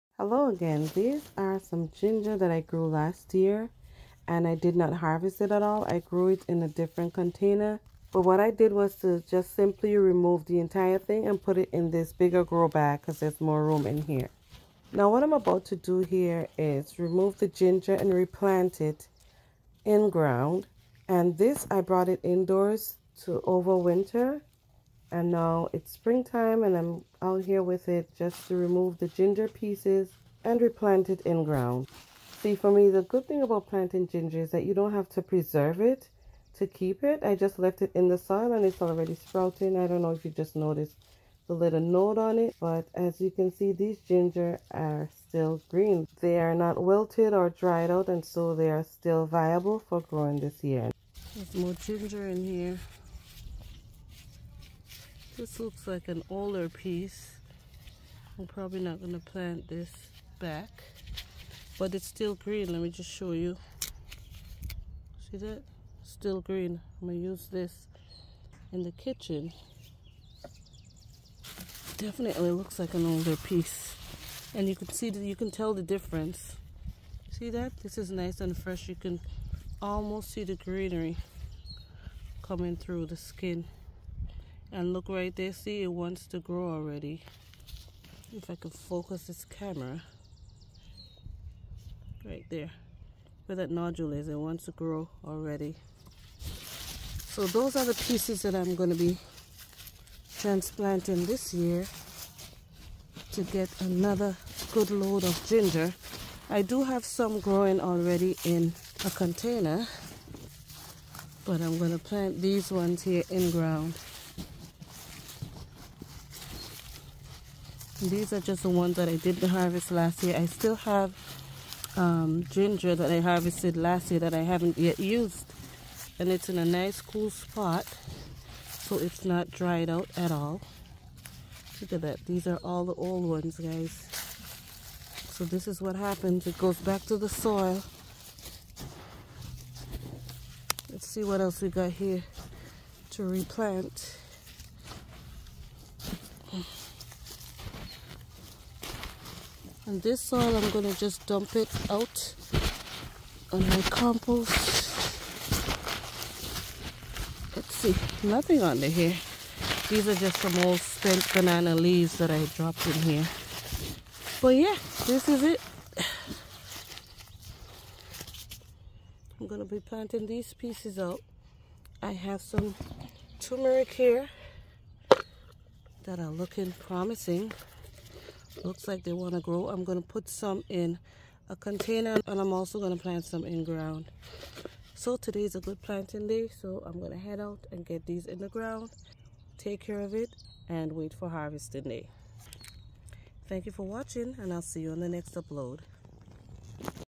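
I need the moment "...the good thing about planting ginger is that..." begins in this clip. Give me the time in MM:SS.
00:32.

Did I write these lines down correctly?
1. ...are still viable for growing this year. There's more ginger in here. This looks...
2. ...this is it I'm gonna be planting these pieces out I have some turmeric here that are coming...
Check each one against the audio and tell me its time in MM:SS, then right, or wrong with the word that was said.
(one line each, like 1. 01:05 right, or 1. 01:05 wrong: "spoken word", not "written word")
1. 00:48 right
2. 02:45 wrong: "looking", not "coming".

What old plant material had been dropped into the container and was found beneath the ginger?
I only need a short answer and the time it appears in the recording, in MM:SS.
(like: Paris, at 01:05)
banana leaves, at 02:41.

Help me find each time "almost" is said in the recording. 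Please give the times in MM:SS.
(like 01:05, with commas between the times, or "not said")
01:19.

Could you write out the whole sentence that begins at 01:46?
I do have some growing already in a container, but I'm going to plant these ones here in ground.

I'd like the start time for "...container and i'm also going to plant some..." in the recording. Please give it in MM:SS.
03:01.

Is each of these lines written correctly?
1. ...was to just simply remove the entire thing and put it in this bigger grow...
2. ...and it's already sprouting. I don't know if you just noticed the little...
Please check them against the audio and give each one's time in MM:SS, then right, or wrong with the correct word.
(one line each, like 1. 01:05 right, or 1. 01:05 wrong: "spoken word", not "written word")
1. 00:08 right
2. 00:38 right.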